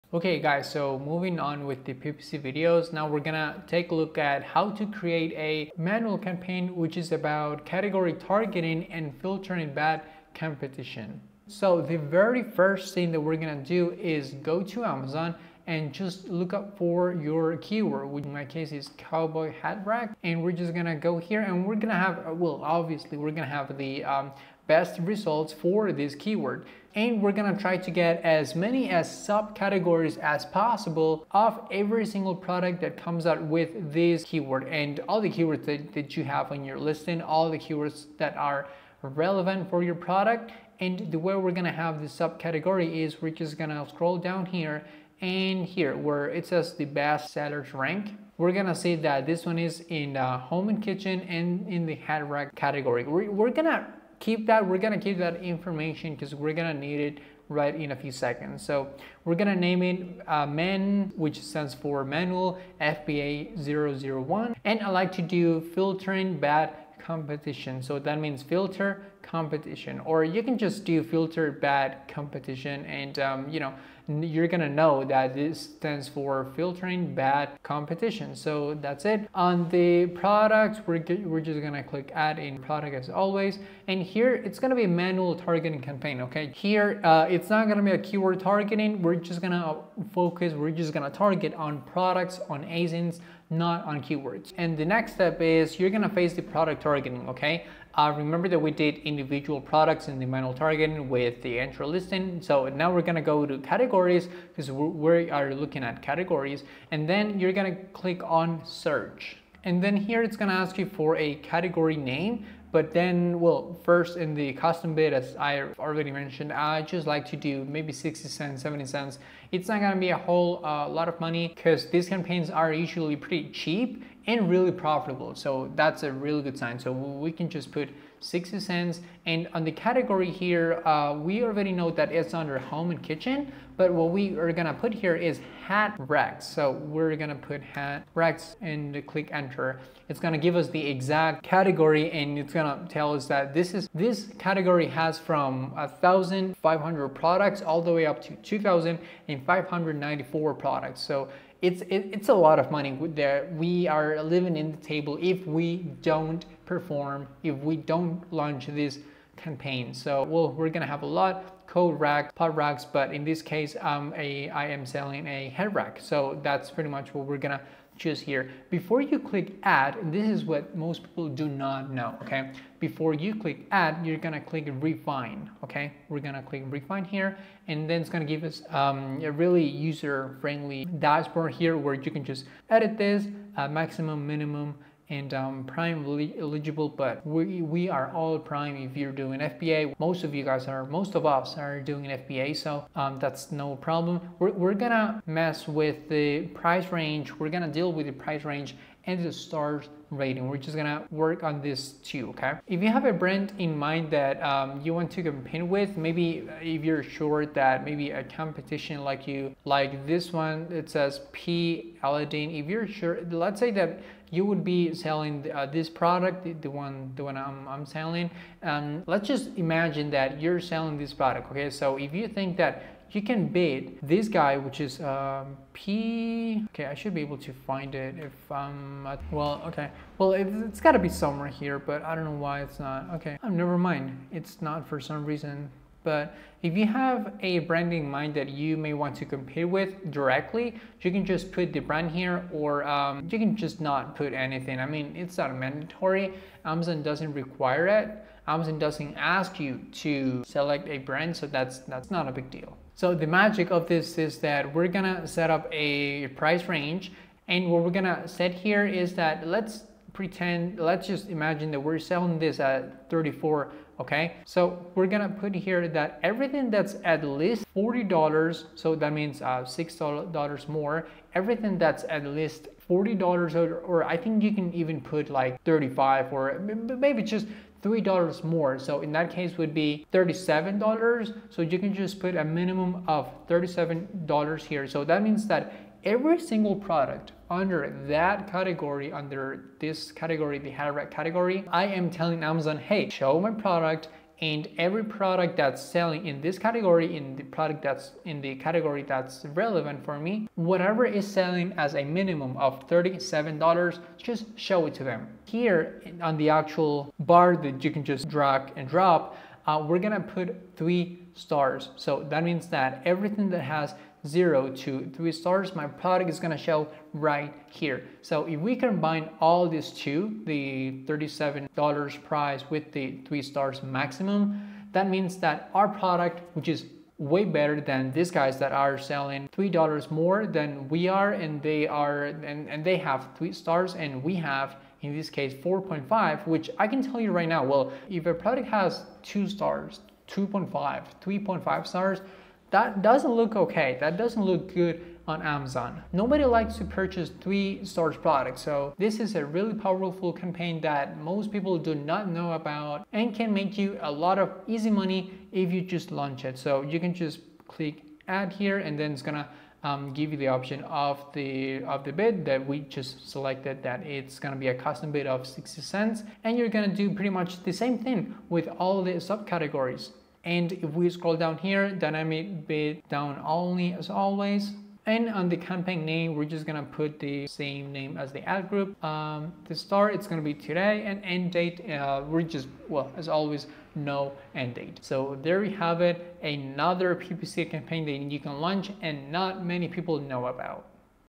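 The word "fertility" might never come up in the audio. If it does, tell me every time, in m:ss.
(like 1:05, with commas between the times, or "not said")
not said.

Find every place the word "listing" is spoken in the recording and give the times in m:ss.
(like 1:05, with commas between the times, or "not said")
0:36, 1:41.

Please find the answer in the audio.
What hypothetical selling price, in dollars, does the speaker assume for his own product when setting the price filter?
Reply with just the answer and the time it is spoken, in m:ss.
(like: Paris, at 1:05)
$34, at 4:23.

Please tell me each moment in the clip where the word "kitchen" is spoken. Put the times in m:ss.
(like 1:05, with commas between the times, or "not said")
0:50, 2:13.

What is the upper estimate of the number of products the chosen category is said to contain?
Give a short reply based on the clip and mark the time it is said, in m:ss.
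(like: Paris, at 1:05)
2,594, at 2:28.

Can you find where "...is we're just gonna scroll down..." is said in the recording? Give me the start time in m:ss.
0:43.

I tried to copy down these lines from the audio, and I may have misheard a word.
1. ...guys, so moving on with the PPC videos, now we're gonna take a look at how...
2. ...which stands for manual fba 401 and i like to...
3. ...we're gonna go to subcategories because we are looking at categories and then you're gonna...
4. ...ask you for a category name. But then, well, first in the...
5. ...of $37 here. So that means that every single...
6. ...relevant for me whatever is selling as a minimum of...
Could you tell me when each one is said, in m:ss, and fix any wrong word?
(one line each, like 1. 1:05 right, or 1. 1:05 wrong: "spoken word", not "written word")
1. 0:00 right
2. 1:01 wrong: "001", not "401"
3. 1:42 wrong: "categories", not "subcategories"
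4. 1:50 right
5. 4:43 right
6. 4:59 right.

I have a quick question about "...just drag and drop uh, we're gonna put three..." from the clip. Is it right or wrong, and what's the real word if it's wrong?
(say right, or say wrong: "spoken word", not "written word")
right.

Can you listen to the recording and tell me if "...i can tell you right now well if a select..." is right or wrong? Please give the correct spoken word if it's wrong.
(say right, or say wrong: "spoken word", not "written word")
wrong: "product", not "select".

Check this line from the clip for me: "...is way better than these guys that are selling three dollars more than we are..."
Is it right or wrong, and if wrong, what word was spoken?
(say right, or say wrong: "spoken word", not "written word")
right.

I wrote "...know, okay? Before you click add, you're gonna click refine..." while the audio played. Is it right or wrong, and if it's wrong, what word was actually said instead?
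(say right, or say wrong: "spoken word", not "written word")
right.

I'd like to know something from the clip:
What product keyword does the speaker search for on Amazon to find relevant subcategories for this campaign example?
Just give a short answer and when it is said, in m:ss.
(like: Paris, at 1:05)
cowboy hat rack, at 0:18.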